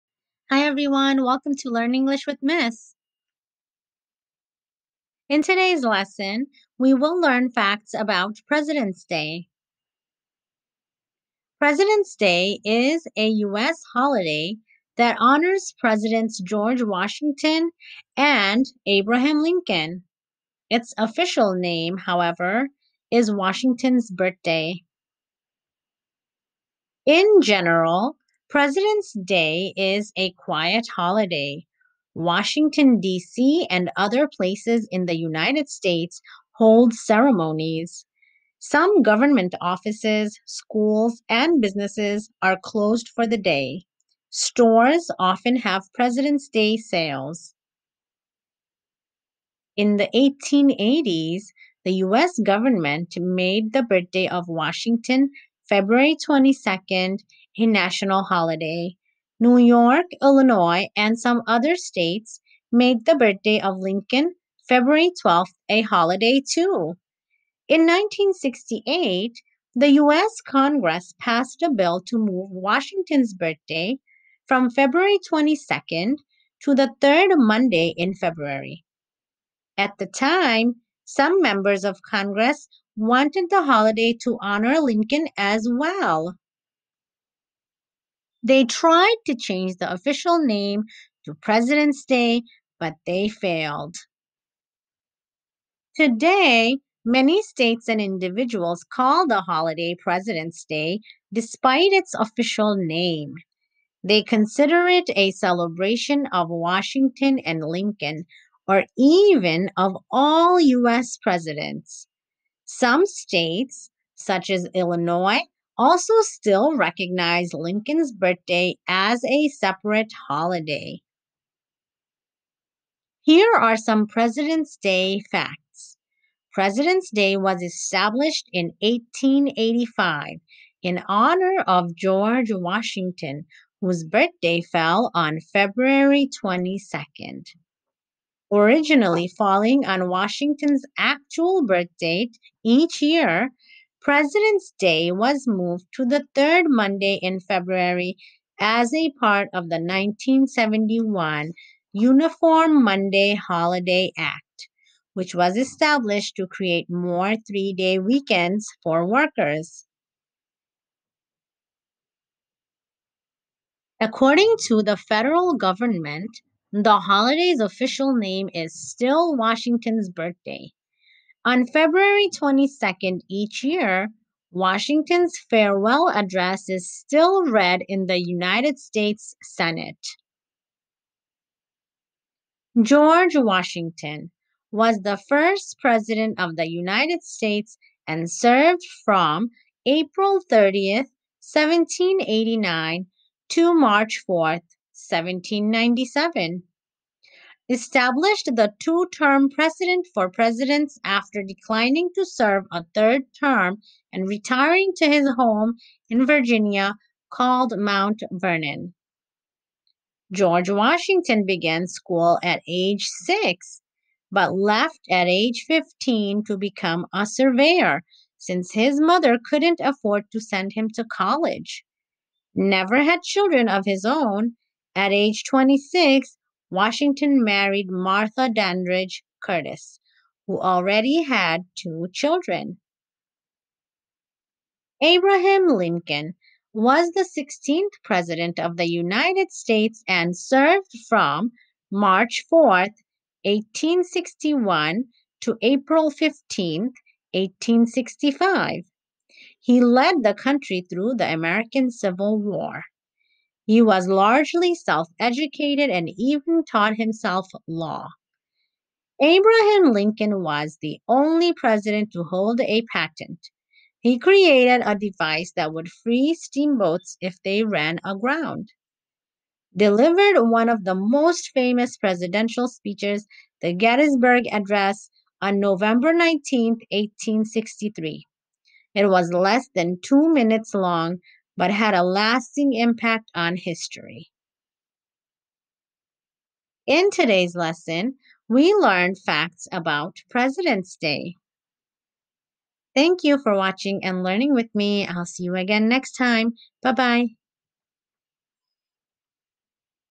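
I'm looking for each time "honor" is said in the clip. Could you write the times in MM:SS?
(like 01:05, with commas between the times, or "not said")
00:15, 01:24, 02:11.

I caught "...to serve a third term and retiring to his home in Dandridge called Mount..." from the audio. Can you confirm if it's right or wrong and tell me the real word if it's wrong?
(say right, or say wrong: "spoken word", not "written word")
wrong: "Virginia", not "Dandridge".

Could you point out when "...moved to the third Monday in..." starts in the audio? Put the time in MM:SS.
02:25.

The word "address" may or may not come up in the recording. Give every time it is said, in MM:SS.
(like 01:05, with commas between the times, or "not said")
02:56, 04:34.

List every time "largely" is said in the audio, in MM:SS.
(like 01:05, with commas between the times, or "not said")
04:14.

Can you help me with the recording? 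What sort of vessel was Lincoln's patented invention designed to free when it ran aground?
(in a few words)
Steamboats.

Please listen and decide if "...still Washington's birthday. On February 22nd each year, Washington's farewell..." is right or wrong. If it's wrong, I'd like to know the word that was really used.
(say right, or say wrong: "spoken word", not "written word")
right.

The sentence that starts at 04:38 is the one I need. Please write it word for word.
It was less than two minutes long, but had a lasting impact on history.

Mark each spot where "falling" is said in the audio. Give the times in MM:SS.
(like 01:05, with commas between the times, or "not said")
02:19.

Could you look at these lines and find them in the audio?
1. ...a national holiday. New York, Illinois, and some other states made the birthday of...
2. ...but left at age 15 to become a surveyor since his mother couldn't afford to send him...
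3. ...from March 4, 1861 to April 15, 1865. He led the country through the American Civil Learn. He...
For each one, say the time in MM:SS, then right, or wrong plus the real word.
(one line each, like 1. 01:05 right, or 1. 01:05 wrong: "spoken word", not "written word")
1. 00:57 right
2. 03:34 right
3. 04:01 wrong: "War", not "Learn".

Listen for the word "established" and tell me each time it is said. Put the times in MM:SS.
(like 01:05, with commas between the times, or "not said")
02:07, 02:35, 03:17.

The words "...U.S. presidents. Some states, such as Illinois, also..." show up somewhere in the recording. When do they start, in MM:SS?
01:50.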